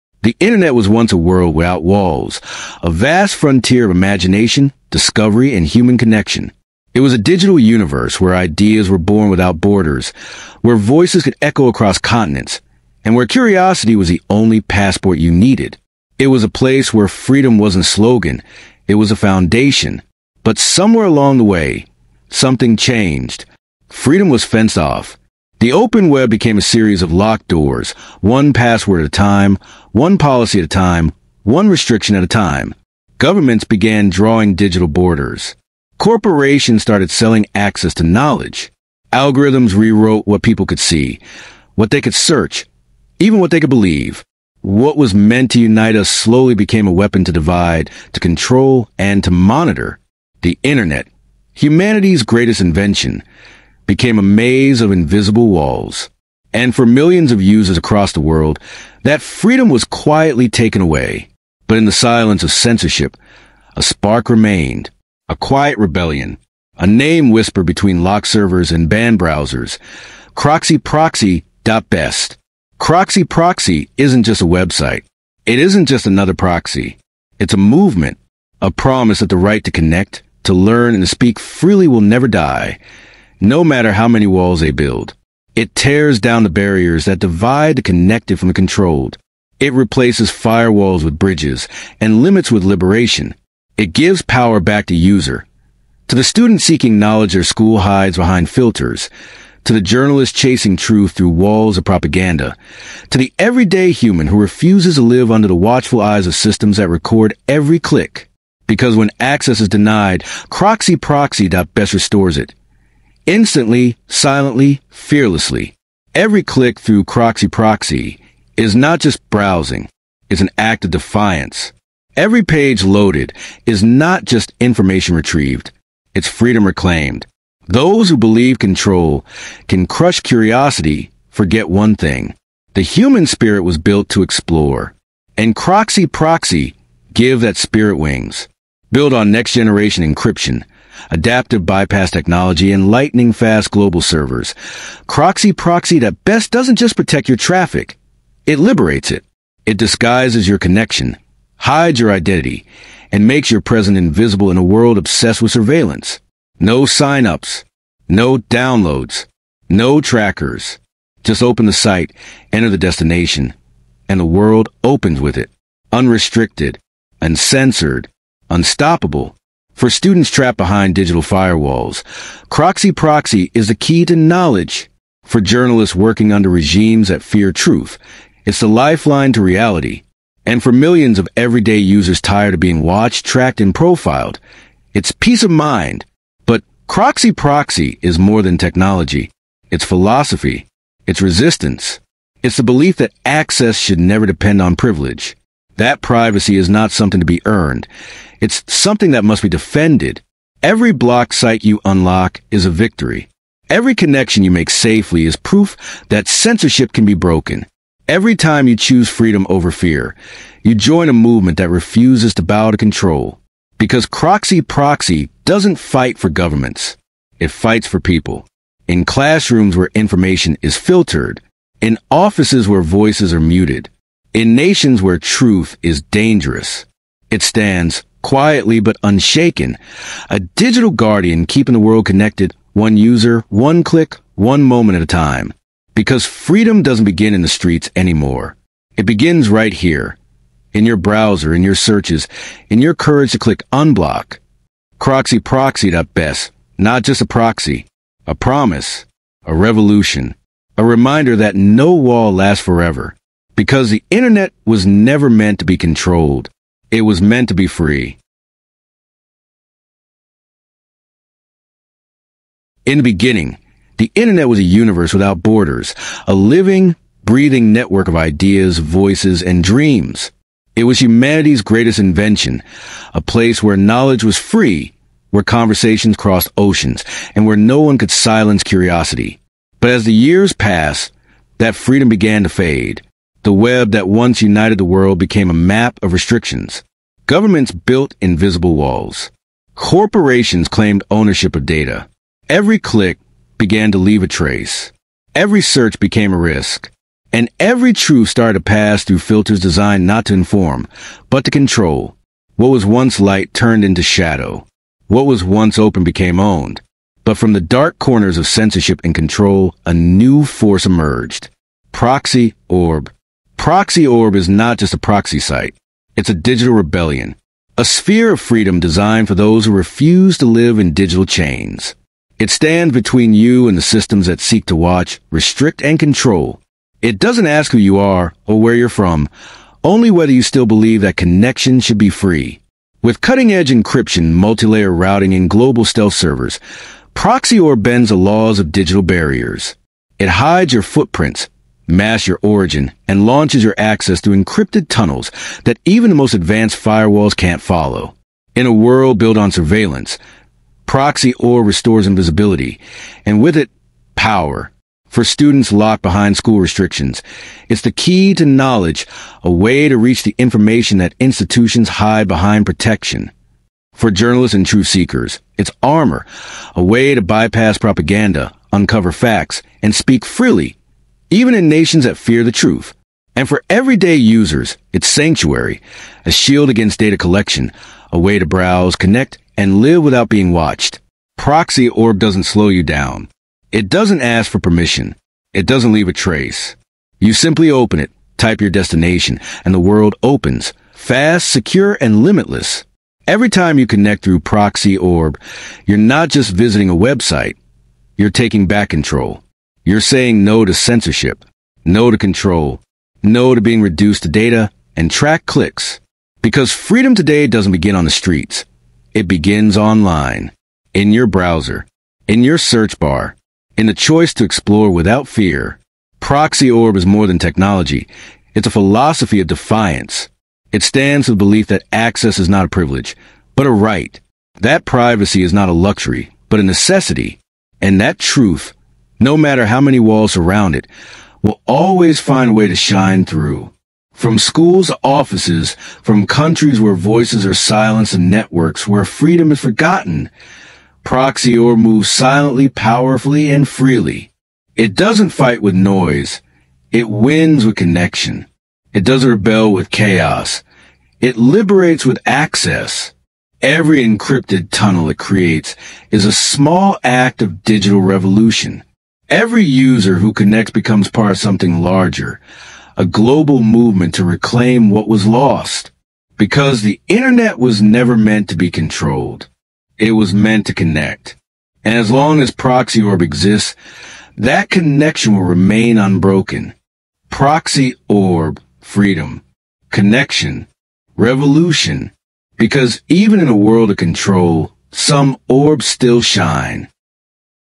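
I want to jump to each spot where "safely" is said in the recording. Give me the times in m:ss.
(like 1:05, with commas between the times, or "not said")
3:24.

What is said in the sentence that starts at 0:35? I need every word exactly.
Corporations started selling access to knowledge.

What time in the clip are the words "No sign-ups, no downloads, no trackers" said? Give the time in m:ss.
2:36.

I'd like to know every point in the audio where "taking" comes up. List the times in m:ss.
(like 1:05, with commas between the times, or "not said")
6:38.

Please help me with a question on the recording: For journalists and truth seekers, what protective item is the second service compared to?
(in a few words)
armor.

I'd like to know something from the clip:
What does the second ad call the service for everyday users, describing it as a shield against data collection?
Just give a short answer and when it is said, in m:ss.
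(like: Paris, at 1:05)
Sanctuary, at 6:15.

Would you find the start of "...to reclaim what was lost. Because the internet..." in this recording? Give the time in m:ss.
7:44.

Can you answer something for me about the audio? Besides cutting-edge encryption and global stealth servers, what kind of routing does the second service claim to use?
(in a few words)
multi-layer routing.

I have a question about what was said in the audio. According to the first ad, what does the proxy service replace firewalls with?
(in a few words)
bridges.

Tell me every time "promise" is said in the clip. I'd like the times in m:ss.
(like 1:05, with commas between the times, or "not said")
1:18, 4:08.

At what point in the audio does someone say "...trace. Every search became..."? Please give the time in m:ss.
4:54.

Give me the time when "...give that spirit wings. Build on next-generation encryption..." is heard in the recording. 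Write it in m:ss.
2:17.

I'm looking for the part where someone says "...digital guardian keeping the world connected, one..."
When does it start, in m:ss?
3:50.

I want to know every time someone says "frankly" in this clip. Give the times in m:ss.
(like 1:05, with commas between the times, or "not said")
not said.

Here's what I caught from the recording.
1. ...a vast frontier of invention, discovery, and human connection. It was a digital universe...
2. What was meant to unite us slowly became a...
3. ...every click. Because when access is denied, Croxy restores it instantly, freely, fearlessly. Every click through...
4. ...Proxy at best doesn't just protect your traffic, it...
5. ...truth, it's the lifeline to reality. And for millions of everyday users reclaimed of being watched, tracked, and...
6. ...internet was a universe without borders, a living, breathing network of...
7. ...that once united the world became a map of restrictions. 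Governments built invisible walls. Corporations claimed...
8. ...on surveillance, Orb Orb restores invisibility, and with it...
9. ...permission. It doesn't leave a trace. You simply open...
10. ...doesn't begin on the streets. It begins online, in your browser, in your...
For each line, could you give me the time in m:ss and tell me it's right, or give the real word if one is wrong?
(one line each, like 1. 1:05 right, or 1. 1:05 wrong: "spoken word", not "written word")
1. 0:02 wrong: "imagination", not "invention"
2. 0:44 right
3. 1:47 wrong: "silently", not "freely"
4. 2:25 right
5. 2:57 wrong: "tired", not "reclaimed"
6. 4:24 right
7. 4:43 right
8. 5:49 wrong: "Proxy", not "Orb"
9. 6:24 right
10. 6:47 right.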